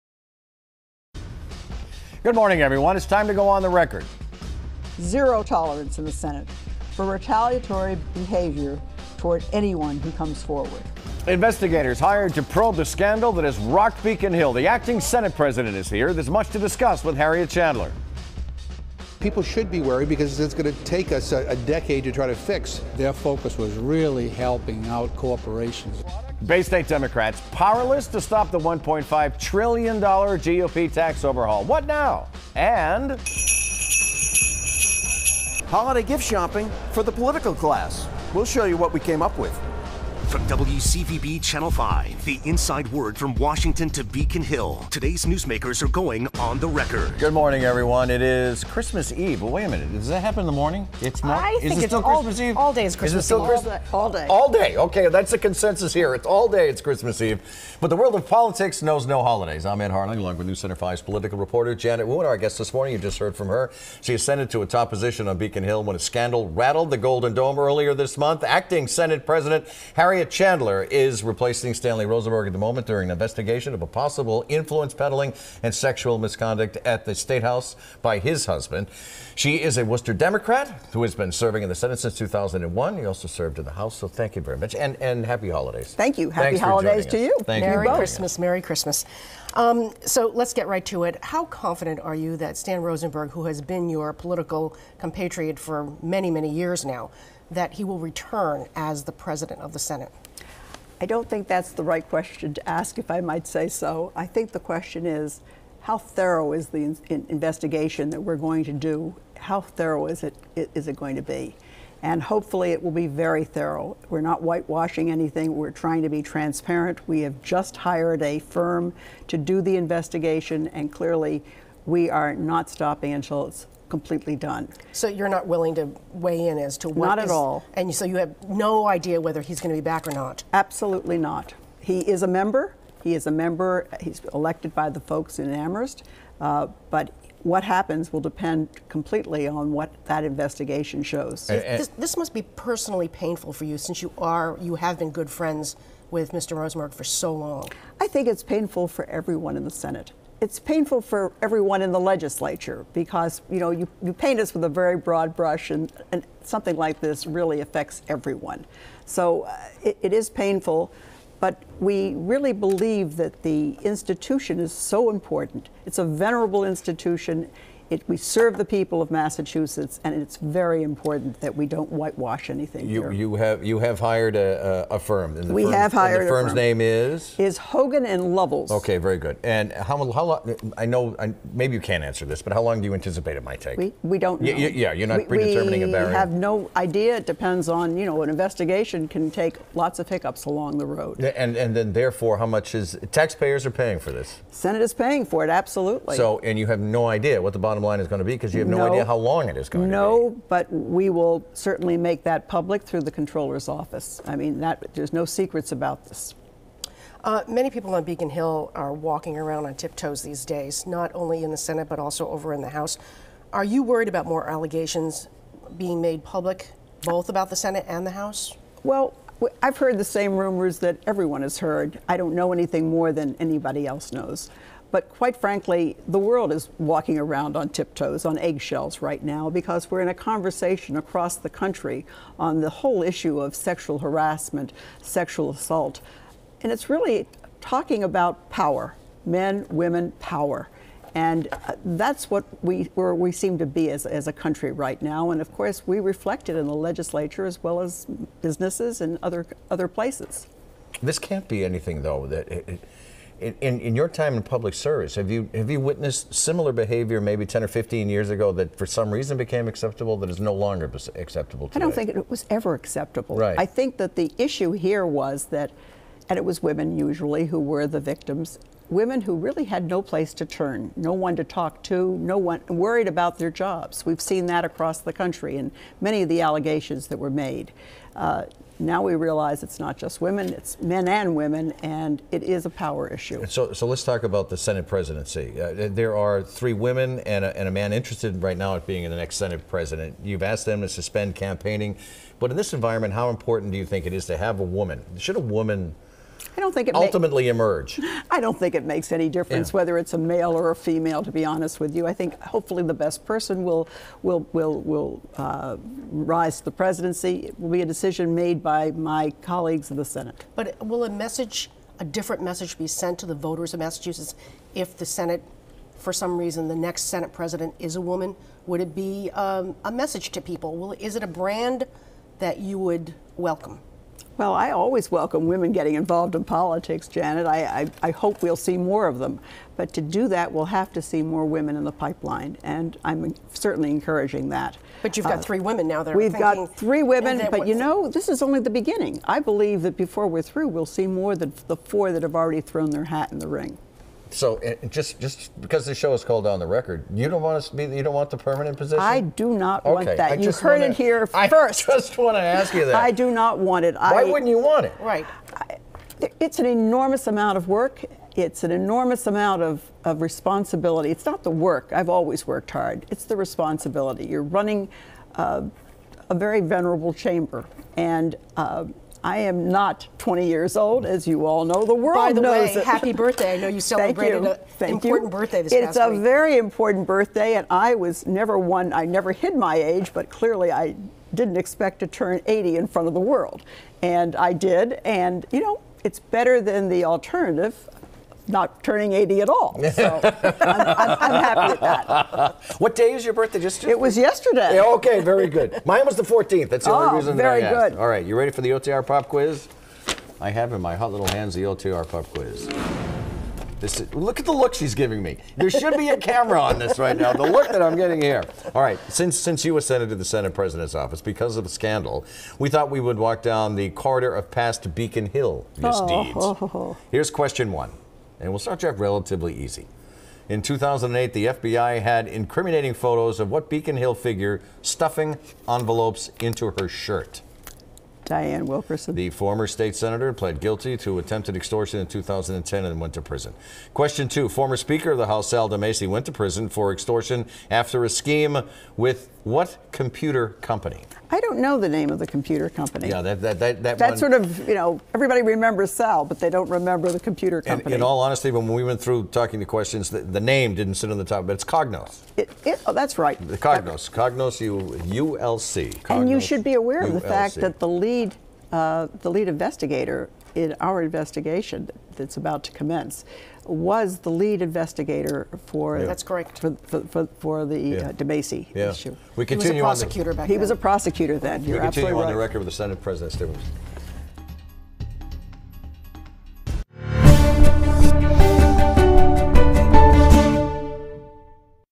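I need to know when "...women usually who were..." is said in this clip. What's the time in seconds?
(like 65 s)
266 s.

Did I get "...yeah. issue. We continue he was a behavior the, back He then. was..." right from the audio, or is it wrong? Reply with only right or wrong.
wrong.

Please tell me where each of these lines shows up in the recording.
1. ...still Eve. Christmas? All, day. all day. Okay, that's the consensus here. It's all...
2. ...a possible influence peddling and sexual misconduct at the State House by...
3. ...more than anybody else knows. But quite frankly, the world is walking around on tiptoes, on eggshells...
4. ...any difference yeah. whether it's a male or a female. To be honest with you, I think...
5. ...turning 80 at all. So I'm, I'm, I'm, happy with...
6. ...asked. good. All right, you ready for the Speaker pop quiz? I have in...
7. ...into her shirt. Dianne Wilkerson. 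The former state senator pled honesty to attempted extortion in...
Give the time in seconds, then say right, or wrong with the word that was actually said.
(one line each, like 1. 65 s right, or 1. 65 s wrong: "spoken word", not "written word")
1. 53 s right
2. 73 s right
3. 222 s right
4. 299 s right
5. 388 s right
6. 397 s wrong: "OTR", not "Speaker"
7. 426 s wrong: "guilty", not "honesty".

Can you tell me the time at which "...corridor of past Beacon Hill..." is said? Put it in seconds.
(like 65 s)
413 s.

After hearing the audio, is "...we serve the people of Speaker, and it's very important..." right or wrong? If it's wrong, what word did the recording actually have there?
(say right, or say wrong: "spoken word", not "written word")
wrong: "Massachusetts", not "Speaker".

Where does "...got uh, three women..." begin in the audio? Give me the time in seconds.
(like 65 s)
335 s.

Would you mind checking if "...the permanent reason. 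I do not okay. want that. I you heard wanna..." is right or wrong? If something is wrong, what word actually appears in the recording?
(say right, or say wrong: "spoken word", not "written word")
wrong: "position", not "reason".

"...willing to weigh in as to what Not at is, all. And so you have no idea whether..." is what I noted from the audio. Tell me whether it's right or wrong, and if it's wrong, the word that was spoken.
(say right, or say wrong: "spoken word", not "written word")
right.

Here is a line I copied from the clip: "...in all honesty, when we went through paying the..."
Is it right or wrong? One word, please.
wrong.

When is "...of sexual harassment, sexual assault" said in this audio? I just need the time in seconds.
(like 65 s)
233 s.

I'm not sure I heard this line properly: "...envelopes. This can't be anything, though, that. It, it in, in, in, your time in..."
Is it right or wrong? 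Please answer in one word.
wrong.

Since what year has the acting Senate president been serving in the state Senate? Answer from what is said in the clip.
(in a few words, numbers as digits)
2001.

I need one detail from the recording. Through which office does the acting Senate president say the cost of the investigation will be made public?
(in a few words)
The controller's office.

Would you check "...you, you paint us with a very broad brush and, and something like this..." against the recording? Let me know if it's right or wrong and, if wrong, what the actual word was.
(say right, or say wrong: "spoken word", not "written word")
right.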